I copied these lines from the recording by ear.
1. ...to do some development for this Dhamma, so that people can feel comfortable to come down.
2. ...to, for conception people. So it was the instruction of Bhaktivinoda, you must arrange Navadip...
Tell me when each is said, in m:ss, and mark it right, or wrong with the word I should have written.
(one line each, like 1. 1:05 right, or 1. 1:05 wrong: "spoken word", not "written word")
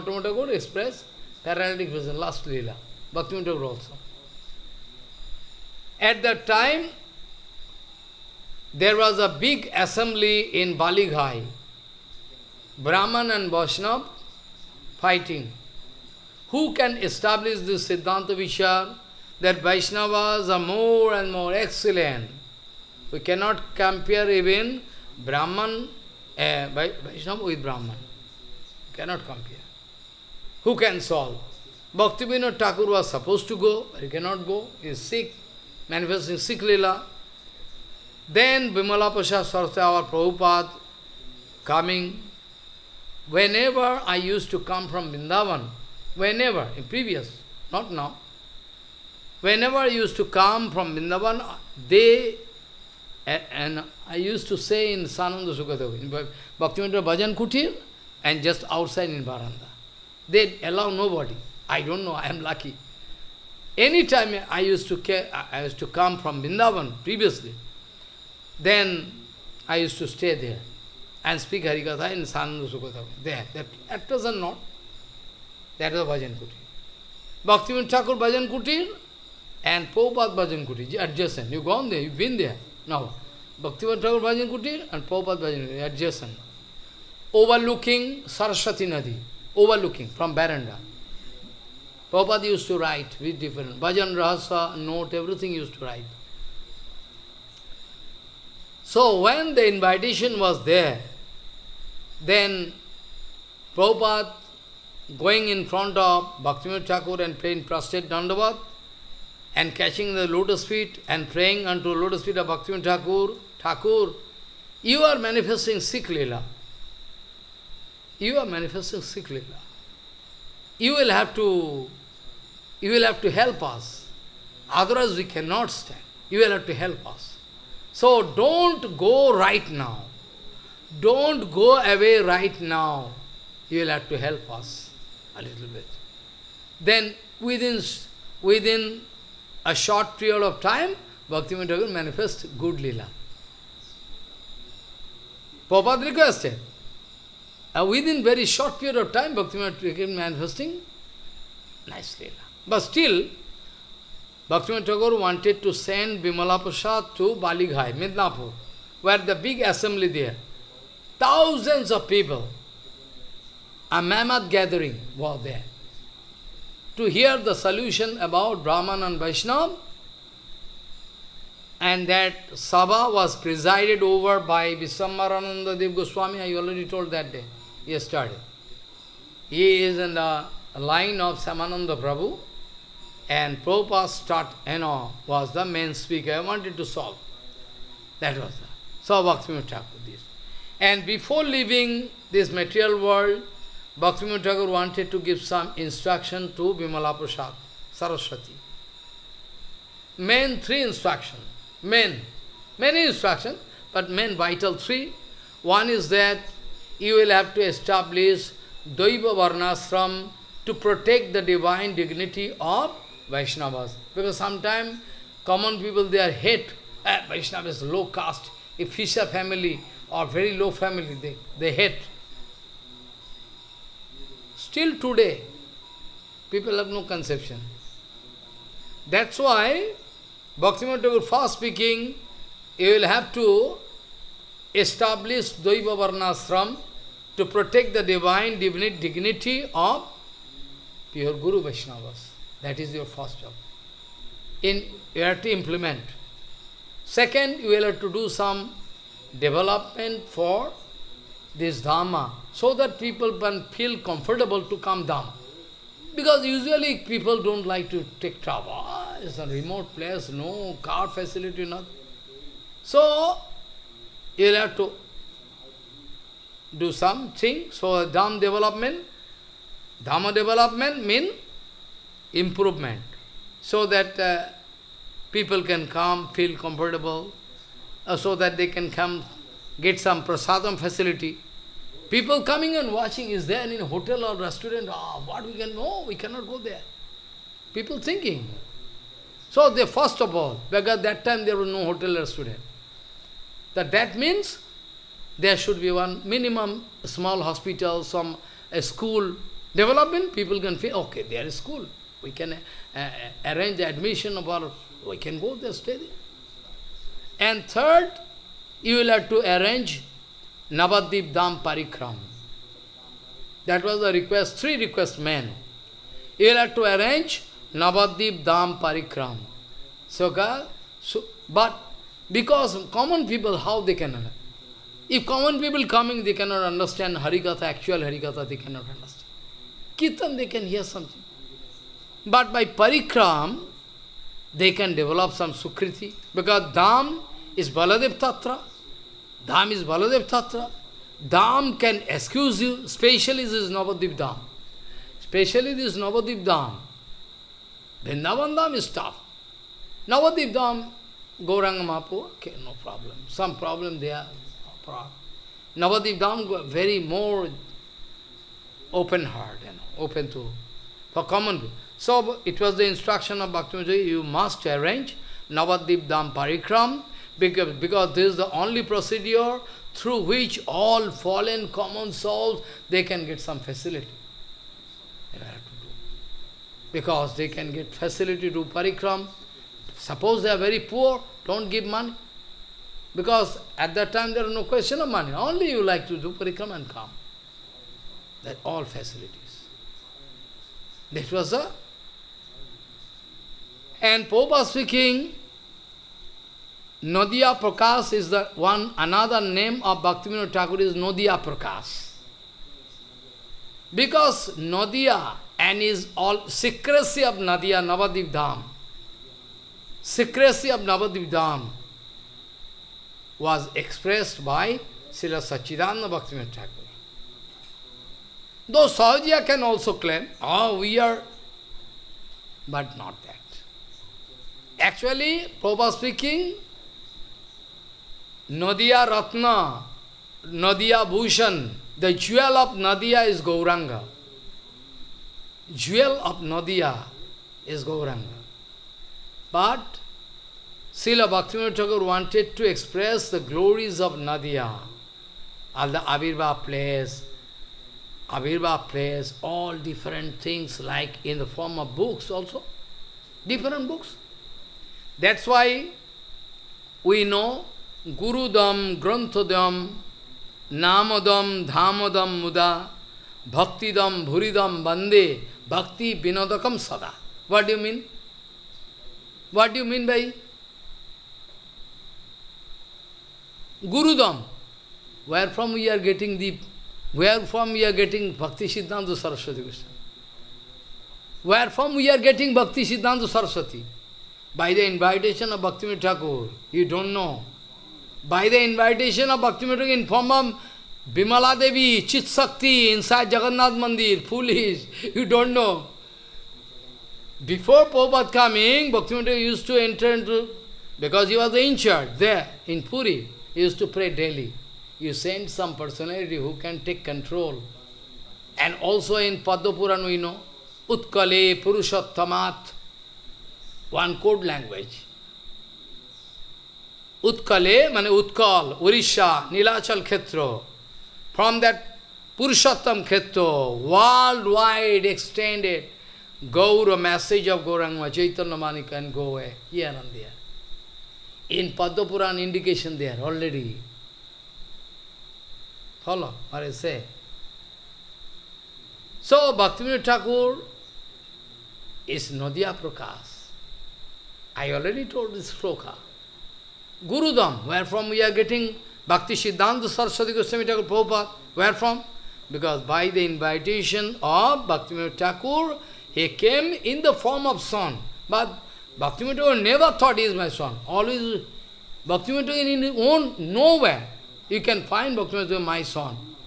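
1. 4:07 right
2. 6:00 wrong: "common", not "conception".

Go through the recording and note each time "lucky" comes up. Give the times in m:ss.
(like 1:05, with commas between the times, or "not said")
1:02.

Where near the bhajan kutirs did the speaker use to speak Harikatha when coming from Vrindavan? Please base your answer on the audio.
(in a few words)
Sananda Sukadeva.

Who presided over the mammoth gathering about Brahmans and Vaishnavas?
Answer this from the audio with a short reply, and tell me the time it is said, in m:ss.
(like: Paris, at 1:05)
Viswamarananda Dev Goswami, at 2:54.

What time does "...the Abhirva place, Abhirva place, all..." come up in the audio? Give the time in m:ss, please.
7:25.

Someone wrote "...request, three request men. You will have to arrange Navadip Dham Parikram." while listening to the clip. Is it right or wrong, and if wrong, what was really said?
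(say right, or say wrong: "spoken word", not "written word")
right.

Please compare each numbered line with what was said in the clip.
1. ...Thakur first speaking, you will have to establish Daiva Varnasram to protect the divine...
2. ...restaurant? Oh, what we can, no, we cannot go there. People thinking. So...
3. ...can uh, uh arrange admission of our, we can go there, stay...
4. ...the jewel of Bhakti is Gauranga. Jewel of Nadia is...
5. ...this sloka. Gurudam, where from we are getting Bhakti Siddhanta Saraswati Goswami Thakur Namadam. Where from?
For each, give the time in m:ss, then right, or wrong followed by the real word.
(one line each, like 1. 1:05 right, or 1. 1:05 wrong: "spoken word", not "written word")
1. 3:51 right
2. 4:44 right
3. 5:02 right
4. 7:11 wrong: "Nadia", not "Bhakti"
5. 9:05 wrong: "Prabhupada", not "Namadam".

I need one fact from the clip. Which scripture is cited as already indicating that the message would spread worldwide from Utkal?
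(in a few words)
Padma Puran.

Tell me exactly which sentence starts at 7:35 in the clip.
That's why we know Gurudam, Granthadam, Namadam, Dhamadam, Muda, Bhaktidam, Bhuridam, Bande, Bhakti, Vinodakam, Sada.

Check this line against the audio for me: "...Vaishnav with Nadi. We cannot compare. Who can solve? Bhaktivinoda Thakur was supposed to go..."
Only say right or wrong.
wrong.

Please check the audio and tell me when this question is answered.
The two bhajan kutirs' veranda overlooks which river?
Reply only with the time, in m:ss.
1:28.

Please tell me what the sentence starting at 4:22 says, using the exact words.
So, you'll have to do something.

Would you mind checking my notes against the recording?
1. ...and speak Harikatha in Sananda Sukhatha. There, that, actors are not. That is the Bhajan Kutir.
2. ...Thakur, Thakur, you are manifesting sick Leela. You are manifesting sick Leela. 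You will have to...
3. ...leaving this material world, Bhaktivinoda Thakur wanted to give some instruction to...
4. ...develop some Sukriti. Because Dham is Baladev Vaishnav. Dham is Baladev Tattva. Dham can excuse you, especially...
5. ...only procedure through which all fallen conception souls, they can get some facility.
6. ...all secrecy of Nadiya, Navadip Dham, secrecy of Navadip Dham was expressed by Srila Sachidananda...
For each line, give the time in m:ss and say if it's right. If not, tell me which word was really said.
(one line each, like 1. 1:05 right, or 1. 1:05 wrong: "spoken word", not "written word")
1. 1:11 right
2. 1:52 right
3. 3:11 right
4. 5:34 wrong: "Tattva", not "Vaishnav"
5. 6:08 wrong: "common", not "conception"
6. 6:46 right.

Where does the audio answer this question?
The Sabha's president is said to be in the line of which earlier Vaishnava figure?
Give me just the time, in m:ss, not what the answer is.
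3:01.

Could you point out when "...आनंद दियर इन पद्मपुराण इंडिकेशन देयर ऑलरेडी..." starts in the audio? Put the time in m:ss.
8:49.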